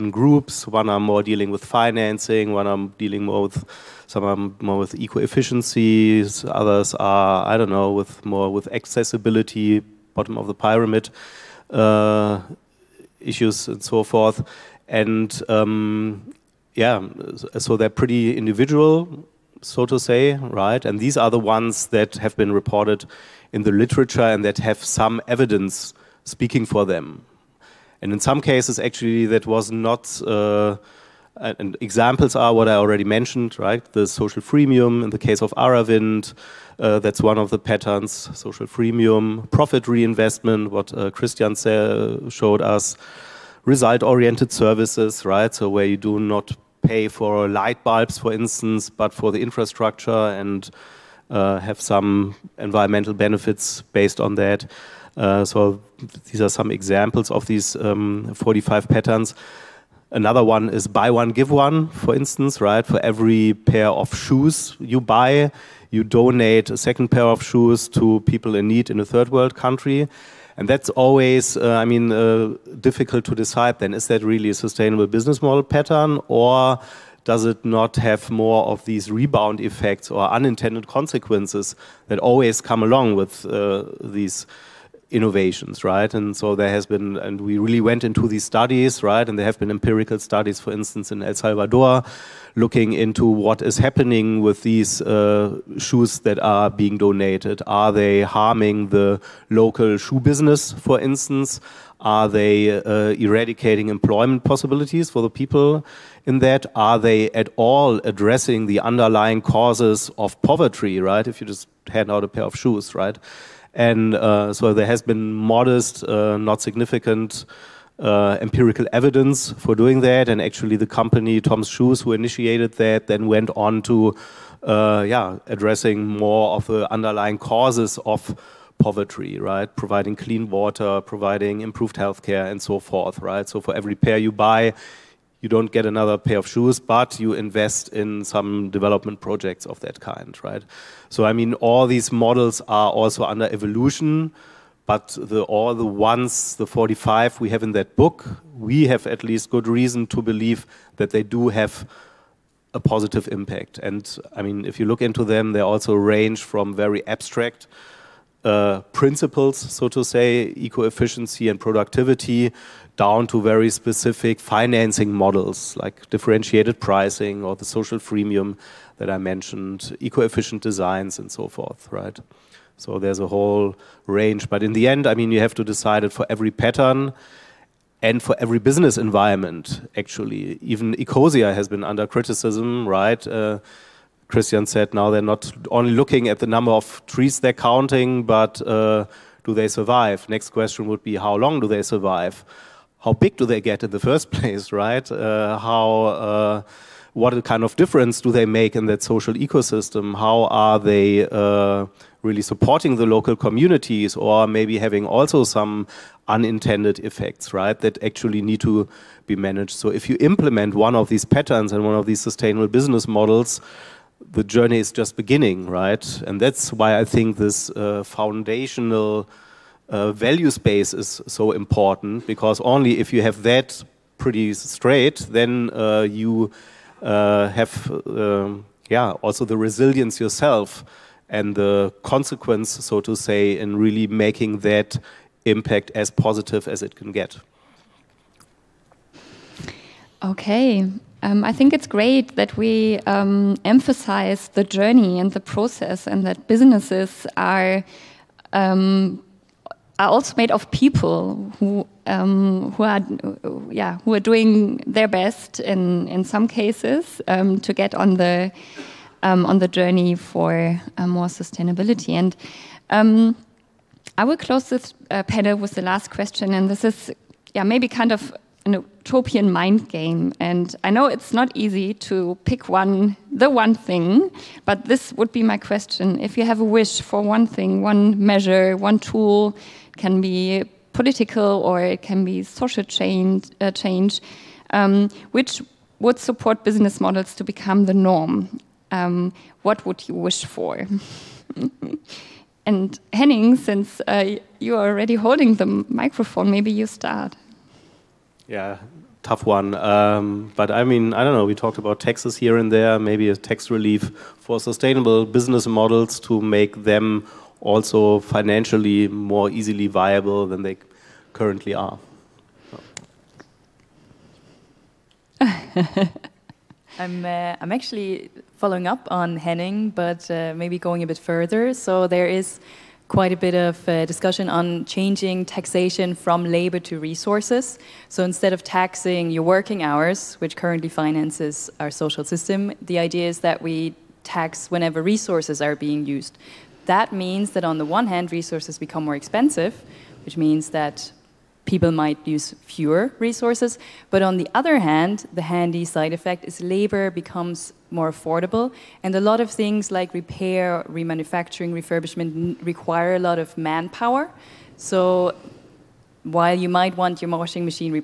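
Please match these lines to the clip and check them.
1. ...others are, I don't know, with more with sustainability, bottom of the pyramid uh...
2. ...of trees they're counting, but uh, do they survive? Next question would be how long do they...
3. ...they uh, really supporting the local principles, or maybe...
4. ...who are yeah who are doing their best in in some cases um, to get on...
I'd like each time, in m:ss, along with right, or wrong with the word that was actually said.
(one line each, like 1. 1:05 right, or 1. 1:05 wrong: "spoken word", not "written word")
1. 0:06 wrong: "accessibility", not "sustainability"
2. 3:06 right
3. 3:20 wrong: "communities", not "principles"
4. 4:12 right.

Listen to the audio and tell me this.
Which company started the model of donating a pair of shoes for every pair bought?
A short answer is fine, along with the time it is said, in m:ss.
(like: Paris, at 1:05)
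Tom's Shoes, at 2:01.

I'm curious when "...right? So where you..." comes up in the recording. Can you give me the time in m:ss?
0:45.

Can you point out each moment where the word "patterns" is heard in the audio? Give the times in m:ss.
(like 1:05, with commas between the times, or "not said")
0:37, 0:58, 1:15, 2:56, 3:31.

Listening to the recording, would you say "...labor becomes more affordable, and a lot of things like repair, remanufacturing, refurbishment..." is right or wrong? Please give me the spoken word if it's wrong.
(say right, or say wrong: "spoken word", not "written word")
right.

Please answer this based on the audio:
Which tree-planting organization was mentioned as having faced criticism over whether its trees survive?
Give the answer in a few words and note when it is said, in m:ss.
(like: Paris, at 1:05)
Ecosia, at 3:00.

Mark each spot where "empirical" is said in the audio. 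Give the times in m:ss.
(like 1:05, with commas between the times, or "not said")
1:29, 1:58.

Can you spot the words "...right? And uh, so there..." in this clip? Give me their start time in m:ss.
1:52.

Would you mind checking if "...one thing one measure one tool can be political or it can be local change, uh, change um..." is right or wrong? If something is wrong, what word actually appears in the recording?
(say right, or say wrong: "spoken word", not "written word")
wrong: "social", not "local".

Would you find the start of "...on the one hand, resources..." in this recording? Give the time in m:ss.
5:37.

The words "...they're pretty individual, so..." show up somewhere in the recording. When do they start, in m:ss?
0:17.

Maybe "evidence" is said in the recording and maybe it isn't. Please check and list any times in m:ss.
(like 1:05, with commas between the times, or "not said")
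0:25, 1:58.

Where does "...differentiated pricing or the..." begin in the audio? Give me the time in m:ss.
2:46.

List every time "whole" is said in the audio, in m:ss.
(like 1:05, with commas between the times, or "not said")
2:53.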